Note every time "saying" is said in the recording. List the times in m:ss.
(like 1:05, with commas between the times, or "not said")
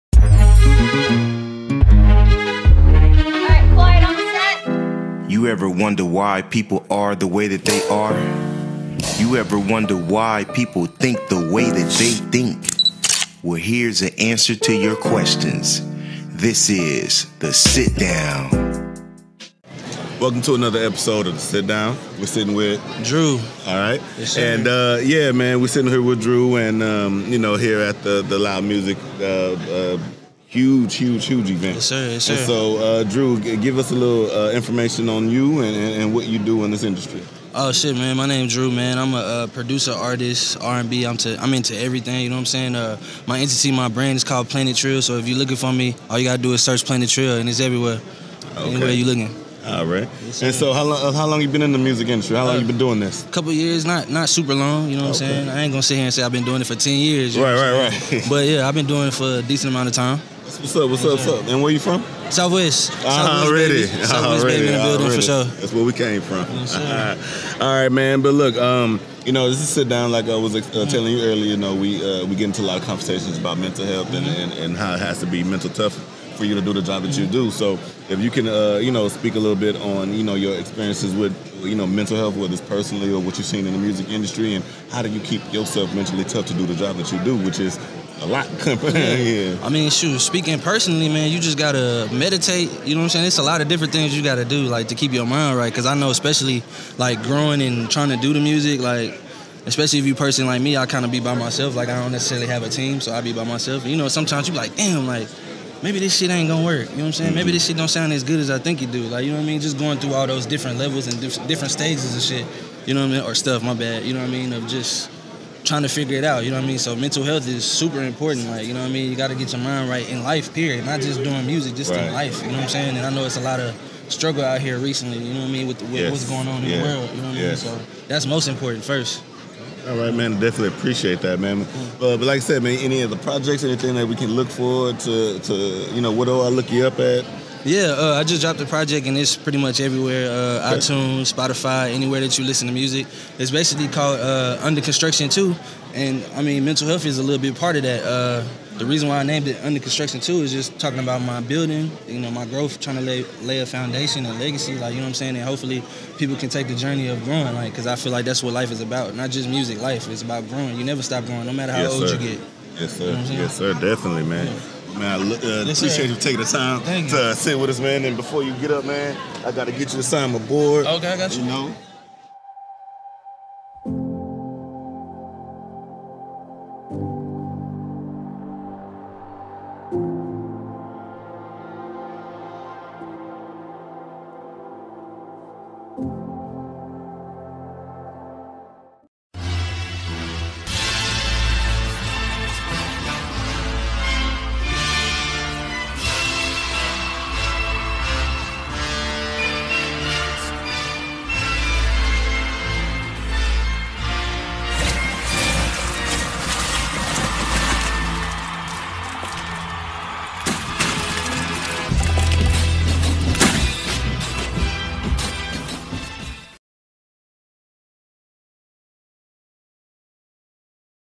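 0:42, 0:55, 1:33, 1:47, 2:02, 2:35.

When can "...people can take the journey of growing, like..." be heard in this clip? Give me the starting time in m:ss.
2:36.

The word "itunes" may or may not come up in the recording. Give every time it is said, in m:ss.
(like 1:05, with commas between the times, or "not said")
2:20.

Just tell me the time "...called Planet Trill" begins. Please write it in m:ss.
0:44.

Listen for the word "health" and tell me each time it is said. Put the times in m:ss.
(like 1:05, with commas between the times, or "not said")
1:13, 1:22, 1:57, 2:26.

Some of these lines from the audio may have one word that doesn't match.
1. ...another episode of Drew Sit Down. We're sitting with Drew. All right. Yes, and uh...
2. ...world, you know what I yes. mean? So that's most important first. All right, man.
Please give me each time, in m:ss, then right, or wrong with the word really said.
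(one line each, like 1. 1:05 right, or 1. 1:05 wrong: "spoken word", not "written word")
1. 0:20 wrong: "The", not "Drew"
2. 2:06 right.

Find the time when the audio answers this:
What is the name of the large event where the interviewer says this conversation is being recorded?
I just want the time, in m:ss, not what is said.
0:28.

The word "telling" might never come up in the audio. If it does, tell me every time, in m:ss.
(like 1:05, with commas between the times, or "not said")
1:10.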